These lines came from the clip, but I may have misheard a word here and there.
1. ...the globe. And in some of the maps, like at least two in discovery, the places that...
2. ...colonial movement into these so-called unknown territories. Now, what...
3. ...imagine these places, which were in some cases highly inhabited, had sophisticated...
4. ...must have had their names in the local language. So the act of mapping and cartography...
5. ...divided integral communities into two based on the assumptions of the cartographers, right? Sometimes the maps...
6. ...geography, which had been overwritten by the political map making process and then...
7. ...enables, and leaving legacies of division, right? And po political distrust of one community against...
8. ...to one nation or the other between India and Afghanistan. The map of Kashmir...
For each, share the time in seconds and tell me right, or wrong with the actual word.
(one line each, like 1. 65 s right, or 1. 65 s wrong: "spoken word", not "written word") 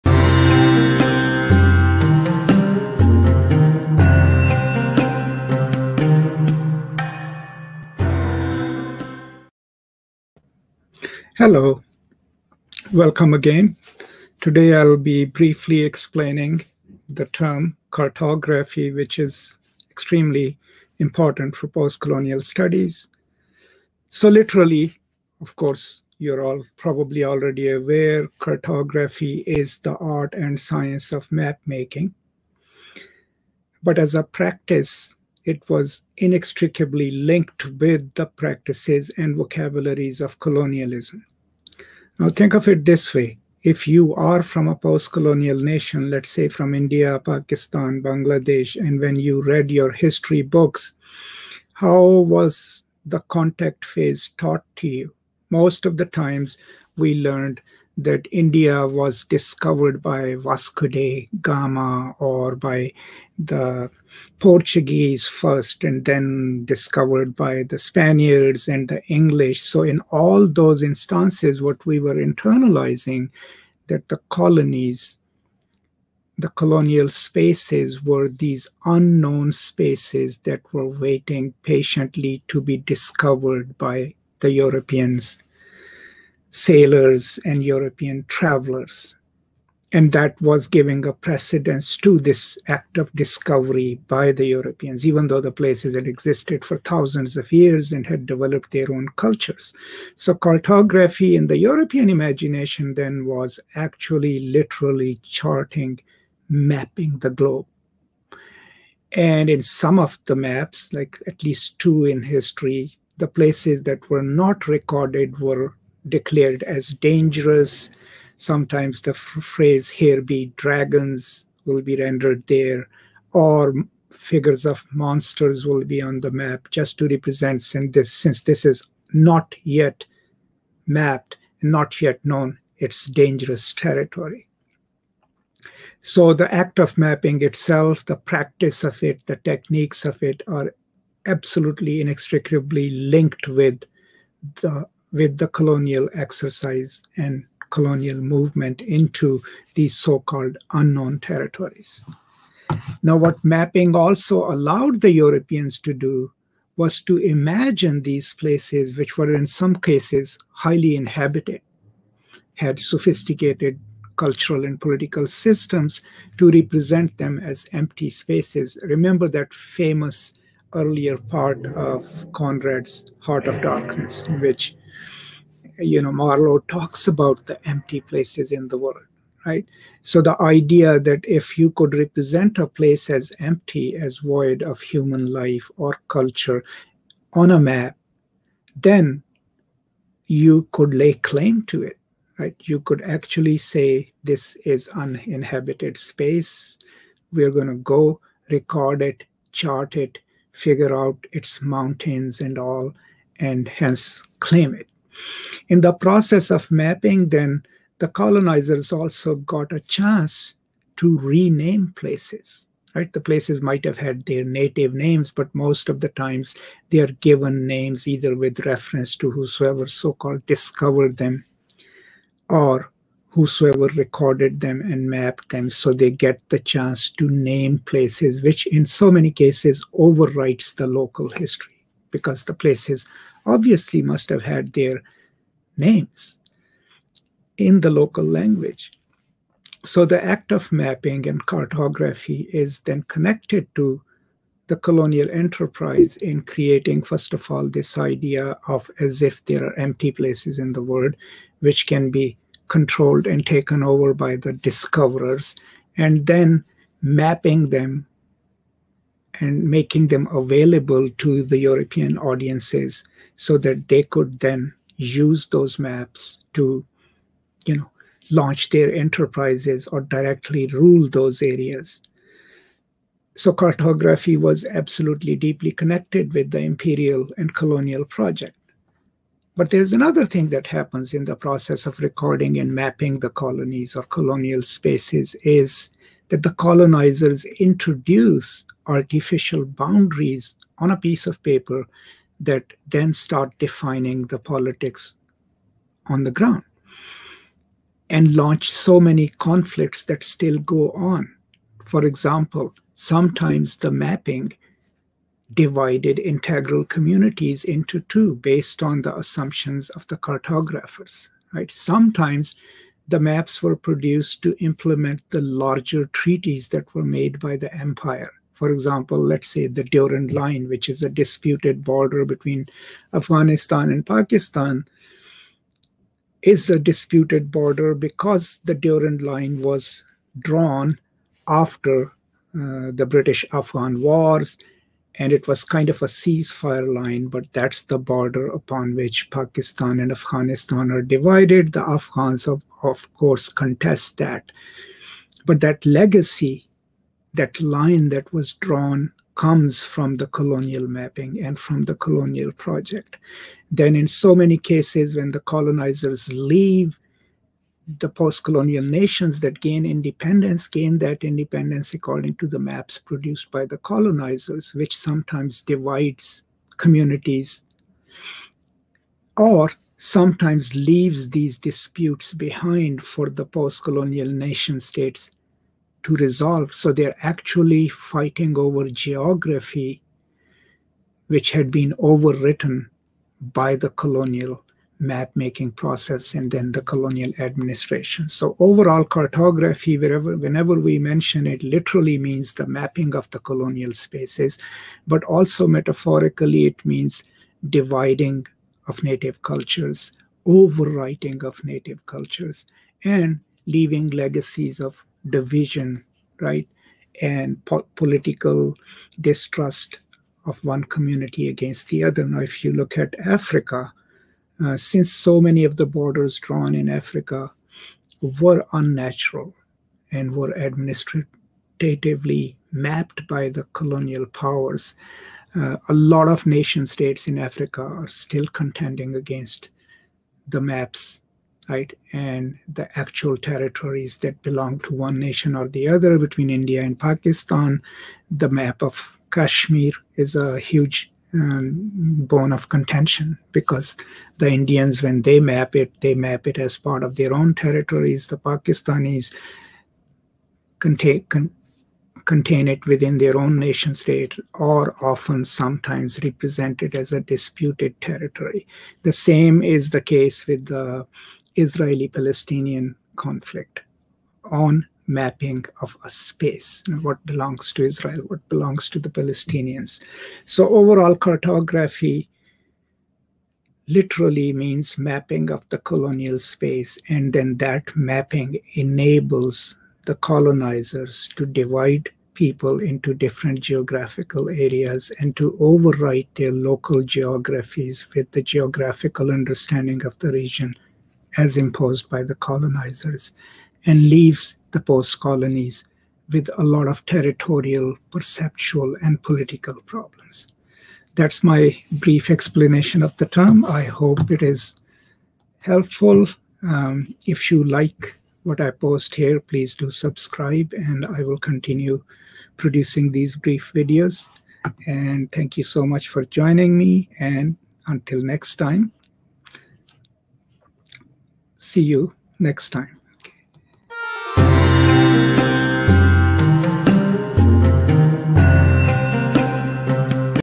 1. 107 s wrong: "history", not "discovery"
2. 147 s right
3. 157 s right
4. 234 s right
5. 305 s right
6. 378 s wrong: "colonial", not "political"
7. 402 s wrong: "cultures", not "enables"
8. 434 s wrong: "Pakistan", not "Afghanistan".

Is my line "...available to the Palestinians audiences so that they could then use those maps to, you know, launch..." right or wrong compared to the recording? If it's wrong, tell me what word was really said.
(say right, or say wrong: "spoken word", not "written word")
wrong: "European", not "Palestinians".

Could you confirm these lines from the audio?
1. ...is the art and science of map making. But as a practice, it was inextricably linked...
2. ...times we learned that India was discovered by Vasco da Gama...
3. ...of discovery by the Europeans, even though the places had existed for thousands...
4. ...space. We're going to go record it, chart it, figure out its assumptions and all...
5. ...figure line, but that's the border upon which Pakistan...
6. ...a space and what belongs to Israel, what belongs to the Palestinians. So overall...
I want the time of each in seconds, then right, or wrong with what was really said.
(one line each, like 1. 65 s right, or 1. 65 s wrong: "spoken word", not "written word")
1. 29 s right
2. 56 s right
3. 92 s right
4. 195 s wrong: "mountains", not "assumptions"
5. 336 s wrong: "ceasefire", not "figure"
6. 466 s right.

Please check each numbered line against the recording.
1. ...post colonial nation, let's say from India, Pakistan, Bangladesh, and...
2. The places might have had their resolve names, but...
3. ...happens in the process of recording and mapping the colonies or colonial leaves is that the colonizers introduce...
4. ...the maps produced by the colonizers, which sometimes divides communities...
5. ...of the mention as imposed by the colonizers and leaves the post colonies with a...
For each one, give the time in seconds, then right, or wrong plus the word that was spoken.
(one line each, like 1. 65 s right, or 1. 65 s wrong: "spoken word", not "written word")
1. 44 s right
2. 213 s wrong: "native", not "resolve"
3. 280 s wrong: "spaces", not "leaves"
4. 362 s right
5. 490 s wrong: "region", not "mention".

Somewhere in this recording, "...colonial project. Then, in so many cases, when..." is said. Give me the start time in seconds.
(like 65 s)
351 s.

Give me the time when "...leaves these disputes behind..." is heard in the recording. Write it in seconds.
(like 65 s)
370 s.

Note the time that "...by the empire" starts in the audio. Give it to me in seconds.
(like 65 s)
317 s.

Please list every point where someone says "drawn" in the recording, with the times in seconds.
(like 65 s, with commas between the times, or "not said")
330 s, 348 s, 416 s.